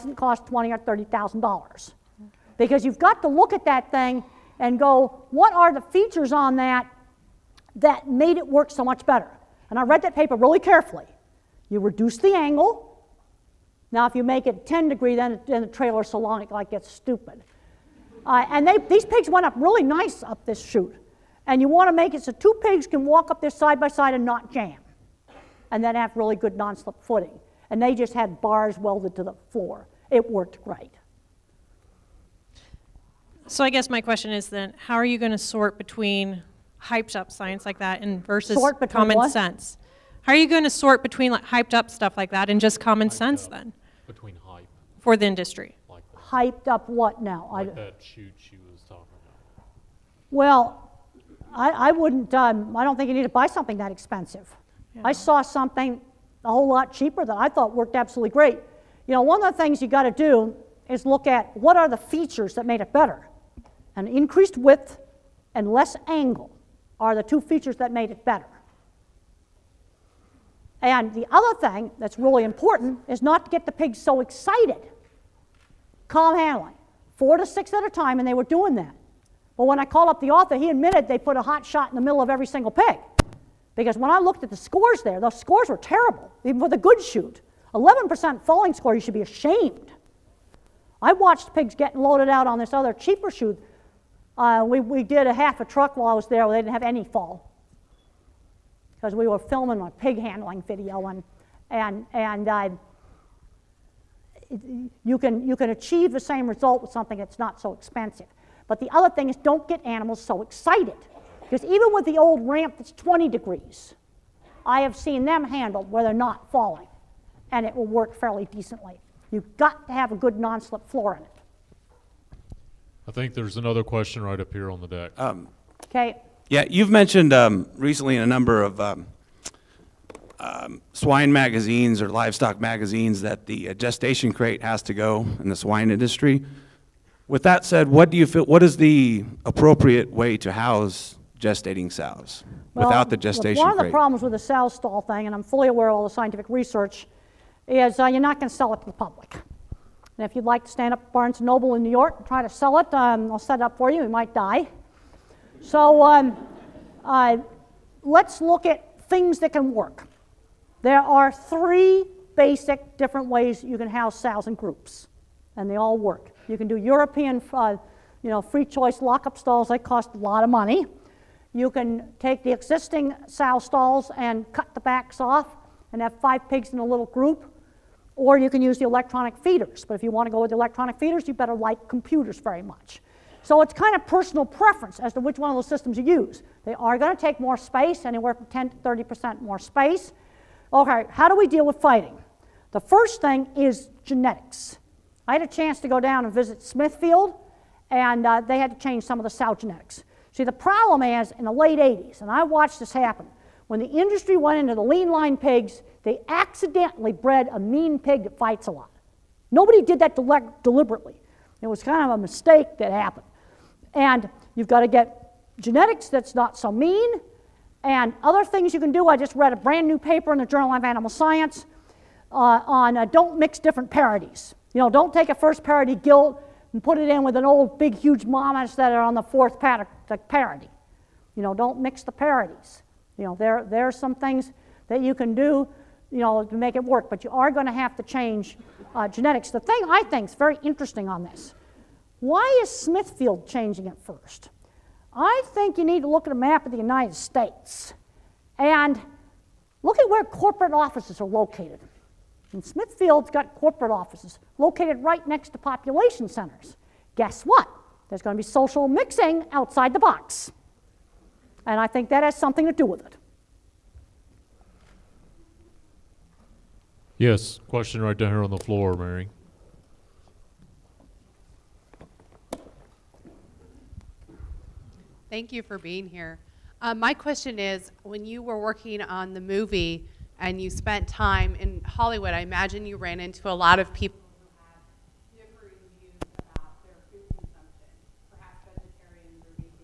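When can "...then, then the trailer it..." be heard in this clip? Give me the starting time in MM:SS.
00:15.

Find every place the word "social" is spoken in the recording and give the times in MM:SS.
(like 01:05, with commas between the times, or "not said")
04:18.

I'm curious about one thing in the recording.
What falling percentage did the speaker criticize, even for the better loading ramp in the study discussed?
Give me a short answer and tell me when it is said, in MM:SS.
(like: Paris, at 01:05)
11%, at 01:27.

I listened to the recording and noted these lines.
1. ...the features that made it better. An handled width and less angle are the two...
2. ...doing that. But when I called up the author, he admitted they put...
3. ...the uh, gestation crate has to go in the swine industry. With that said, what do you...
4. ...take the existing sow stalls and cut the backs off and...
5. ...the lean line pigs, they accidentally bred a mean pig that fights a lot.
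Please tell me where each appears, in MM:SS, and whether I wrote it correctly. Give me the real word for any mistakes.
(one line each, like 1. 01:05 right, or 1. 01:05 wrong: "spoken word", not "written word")
1. 01:01 wrong: "increased", not "handled"
2. 01:18 right
3. 02:13 right
4. 02:52 right
5. 03:24 right.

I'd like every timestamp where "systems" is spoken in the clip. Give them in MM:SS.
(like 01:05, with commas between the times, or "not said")
03:05.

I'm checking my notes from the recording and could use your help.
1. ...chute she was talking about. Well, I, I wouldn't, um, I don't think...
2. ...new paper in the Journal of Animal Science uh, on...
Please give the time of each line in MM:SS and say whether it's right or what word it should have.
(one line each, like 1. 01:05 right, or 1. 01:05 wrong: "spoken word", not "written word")
1. 00:48 right
2. 03:39 right.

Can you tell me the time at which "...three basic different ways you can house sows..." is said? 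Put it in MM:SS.
02:41.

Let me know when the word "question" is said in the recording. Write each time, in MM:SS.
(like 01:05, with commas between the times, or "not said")
00:33, 02:03, 04:27, 04:37.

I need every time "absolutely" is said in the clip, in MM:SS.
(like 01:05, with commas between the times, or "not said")
00:57.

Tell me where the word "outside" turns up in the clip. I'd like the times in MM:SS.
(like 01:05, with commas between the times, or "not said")
04:19.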